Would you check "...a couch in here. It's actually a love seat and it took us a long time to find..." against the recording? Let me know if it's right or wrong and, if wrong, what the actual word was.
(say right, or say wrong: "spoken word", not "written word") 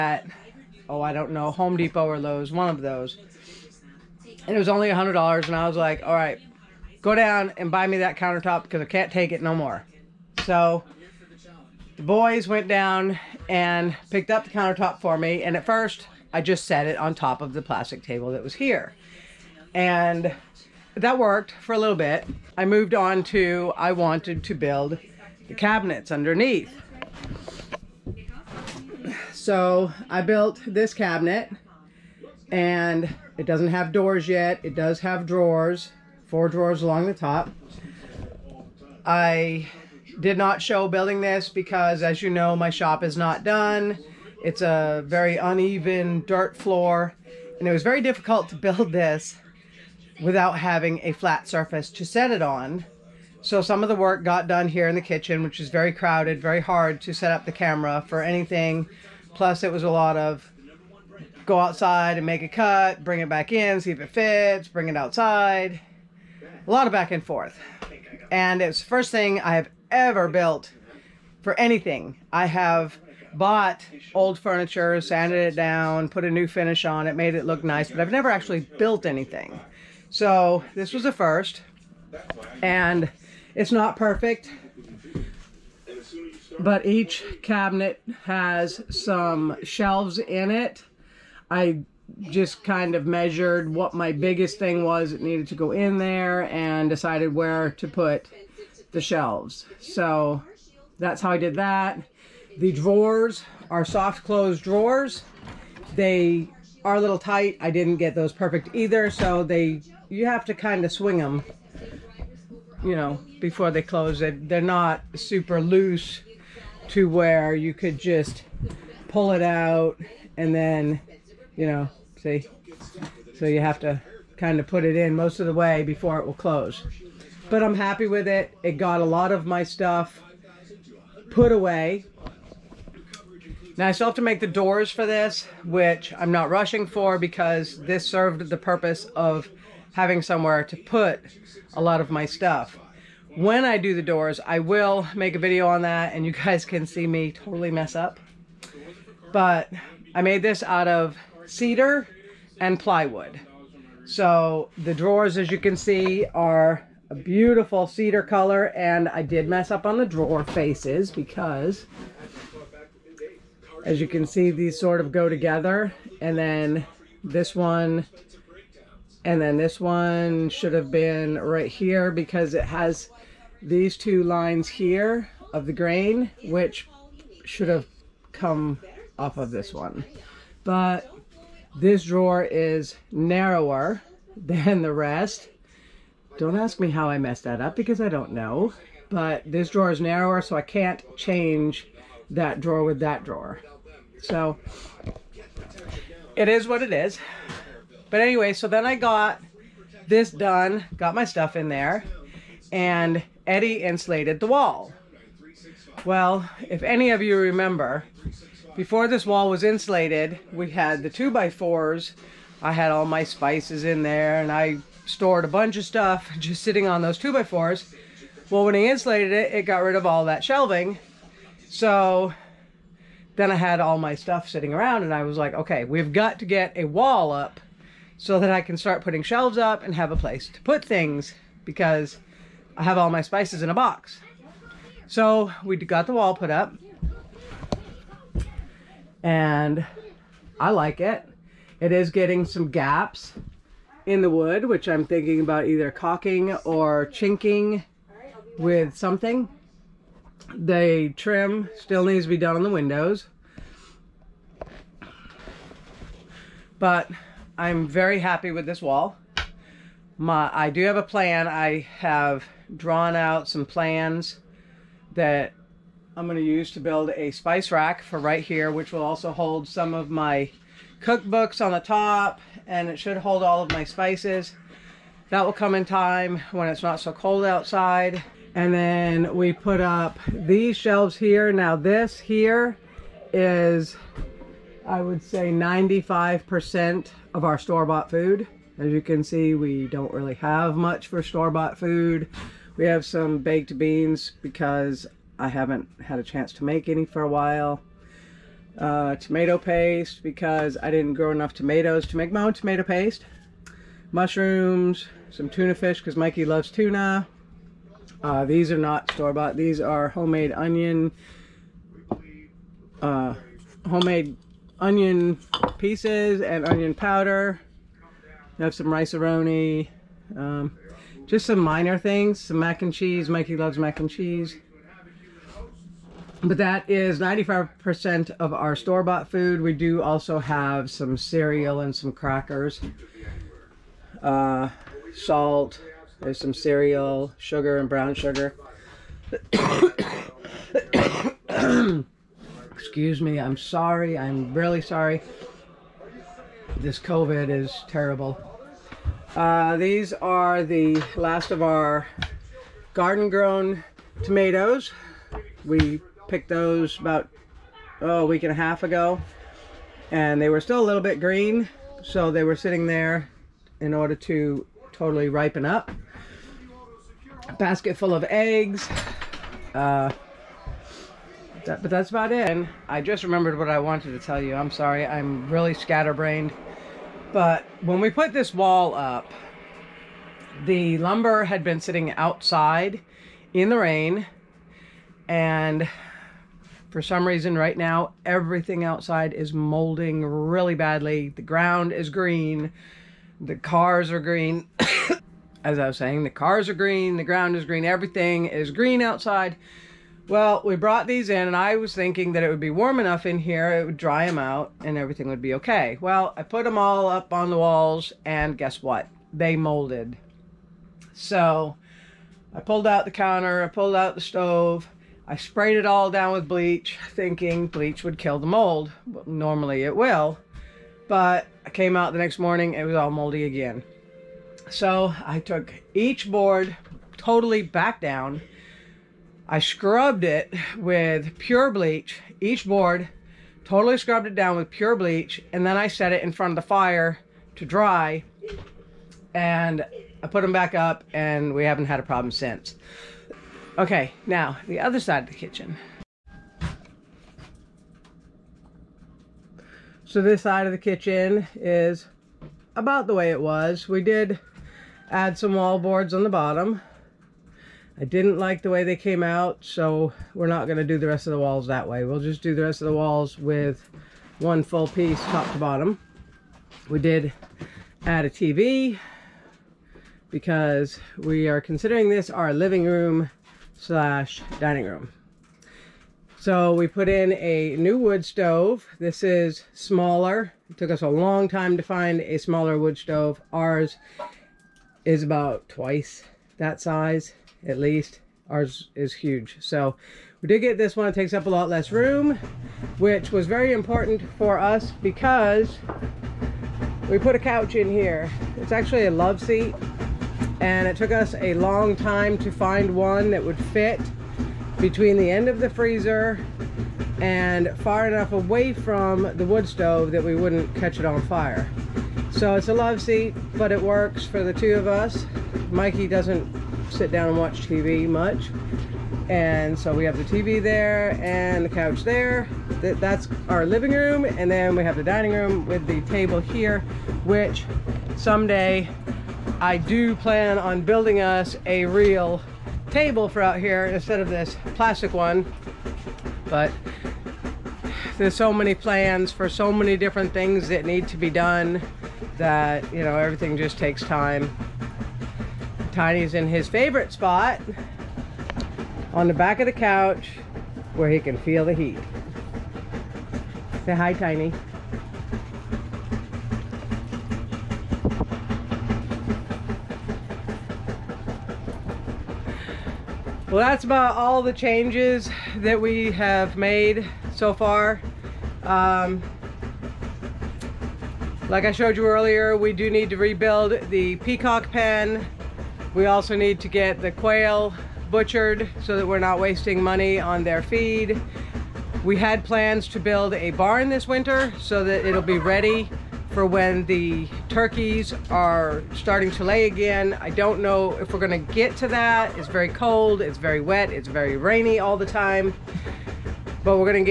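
right.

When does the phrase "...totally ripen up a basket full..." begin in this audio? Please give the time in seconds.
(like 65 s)
364 s.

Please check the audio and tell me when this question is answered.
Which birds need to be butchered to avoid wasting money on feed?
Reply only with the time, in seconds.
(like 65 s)
577 s.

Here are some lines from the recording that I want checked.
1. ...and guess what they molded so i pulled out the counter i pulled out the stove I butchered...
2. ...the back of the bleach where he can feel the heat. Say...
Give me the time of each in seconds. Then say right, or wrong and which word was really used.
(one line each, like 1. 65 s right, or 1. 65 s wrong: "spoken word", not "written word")
1. 408 s wrong: "sprayed", not "butchered"
2. 549 s wrong: "couch", not "bleach".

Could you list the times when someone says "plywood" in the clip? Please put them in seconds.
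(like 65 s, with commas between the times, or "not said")
152 s.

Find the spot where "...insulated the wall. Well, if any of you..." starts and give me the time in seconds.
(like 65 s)
203 s.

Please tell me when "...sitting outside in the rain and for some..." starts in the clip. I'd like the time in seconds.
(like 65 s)
381 s.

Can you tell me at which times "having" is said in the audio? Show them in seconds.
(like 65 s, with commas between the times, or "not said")
50 s, 139 s.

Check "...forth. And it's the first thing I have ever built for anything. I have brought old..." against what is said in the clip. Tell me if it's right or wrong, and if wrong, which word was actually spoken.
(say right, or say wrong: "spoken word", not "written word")
wrong: "bought", not "brought".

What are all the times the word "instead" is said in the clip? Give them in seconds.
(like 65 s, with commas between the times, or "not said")
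533 s.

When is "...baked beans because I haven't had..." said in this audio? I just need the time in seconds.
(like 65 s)
293 s.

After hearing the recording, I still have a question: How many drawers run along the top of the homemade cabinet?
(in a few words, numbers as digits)
4.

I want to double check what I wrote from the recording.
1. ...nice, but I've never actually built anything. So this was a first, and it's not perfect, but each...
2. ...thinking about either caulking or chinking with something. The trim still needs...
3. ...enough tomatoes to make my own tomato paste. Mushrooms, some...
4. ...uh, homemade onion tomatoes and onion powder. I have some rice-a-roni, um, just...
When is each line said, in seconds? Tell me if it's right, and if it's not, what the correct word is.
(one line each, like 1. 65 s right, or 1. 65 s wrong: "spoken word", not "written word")
1. 77 s right
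2. 245 s right
3. 301 s right
4. 313 s wrong: "pieces", not "tomatoes".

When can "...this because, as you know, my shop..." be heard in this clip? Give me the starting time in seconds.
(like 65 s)
41 s.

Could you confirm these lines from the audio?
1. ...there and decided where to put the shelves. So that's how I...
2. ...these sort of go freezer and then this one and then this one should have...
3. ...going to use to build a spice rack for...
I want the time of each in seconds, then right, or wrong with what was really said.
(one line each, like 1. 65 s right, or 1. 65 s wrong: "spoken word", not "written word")
1. 95 s right
2. 164 s wrong: "together", not "freezer"
3. 266 s right.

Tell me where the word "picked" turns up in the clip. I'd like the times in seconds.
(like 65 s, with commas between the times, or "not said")
14 s, 356 s.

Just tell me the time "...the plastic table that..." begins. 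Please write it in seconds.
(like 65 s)
17 s.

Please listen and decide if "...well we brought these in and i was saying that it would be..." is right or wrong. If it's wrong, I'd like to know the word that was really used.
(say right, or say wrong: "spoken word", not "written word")
wrong: "thinking", not "saying".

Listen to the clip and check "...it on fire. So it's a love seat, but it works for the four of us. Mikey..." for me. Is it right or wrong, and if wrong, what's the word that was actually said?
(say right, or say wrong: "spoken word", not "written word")
wrong: "two", not "four".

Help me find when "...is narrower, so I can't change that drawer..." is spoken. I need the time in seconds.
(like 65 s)
189 s.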